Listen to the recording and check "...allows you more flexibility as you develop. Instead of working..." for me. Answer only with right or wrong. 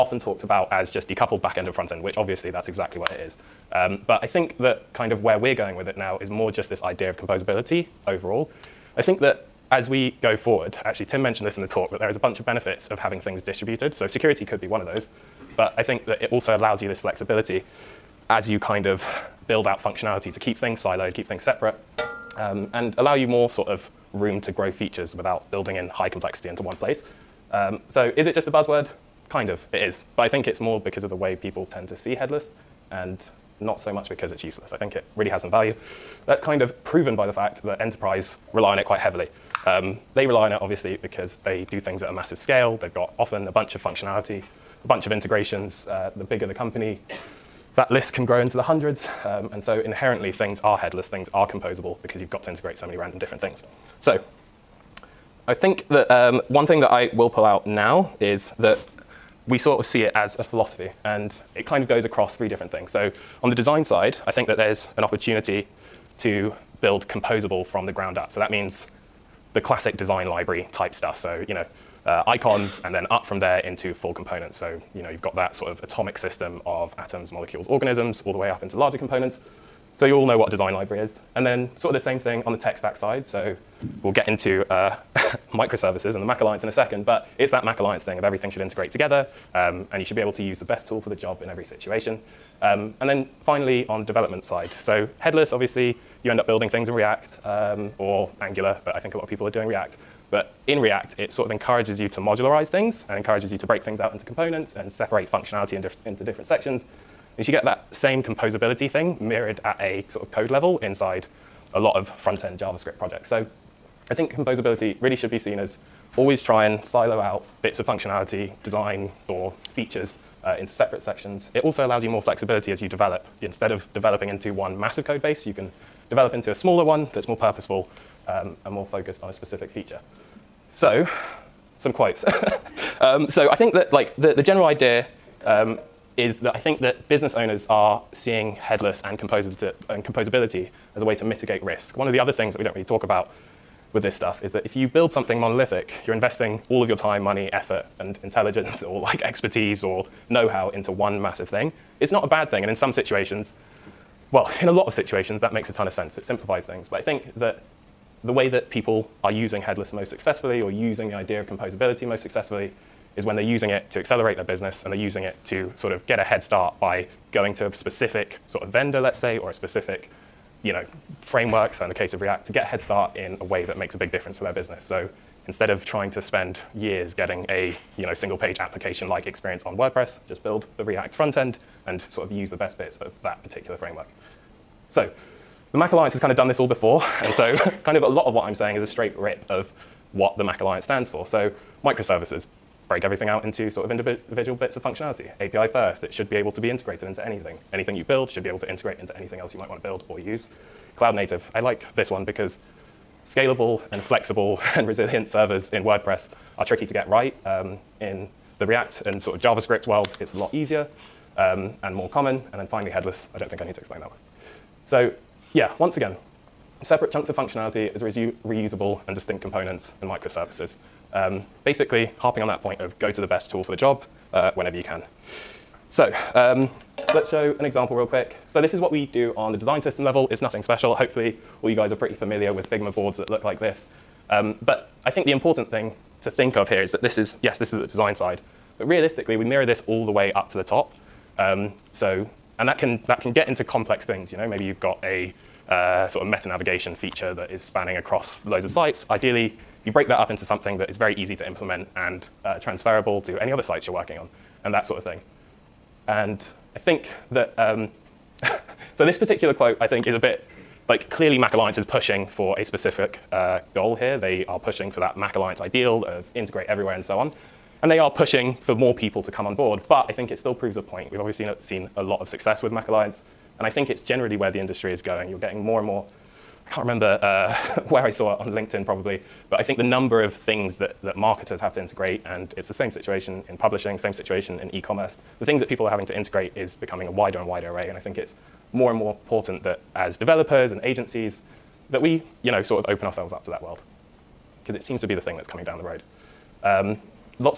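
wrong.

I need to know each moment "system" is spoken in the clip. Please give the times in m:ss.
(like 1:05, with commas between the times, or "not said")
1:16, 3:49.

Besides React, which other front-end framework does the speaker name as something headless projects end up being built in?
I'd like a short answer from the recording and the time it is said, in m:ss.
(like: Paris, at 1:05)
Angular, at 1:38.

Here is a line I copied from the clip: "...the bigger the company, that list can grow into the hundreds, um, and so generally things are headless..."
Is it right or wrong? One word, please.
wrong.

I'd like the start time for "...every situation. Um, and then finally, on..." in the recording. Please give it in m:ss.
1:31.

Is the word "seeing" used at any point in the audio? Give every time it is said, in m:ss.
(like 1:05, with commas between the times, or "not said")
2:18.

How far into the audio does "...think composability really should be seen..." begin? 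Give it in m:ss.
1:54.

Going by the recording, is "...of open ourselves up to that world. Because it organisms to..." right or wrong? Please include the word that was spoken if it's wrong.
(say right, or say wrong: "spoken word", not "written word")
wrong: "seems", not "organisms".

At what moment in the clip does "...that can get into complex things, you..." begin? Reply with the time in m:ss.
4:03.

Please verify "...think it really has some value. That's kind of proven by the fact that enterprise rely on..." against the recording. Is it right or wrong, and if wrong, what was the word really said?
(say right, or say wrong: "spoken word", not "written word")
right.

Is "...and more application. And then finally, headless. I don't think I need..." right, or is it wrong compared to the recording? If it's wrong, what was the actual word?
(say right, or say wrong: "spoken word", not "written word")
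wrong: "common", not "application".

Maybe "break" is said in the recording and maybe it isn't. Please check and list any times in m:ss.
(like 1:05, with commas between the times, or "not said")
1:43, 3:12, 4:09.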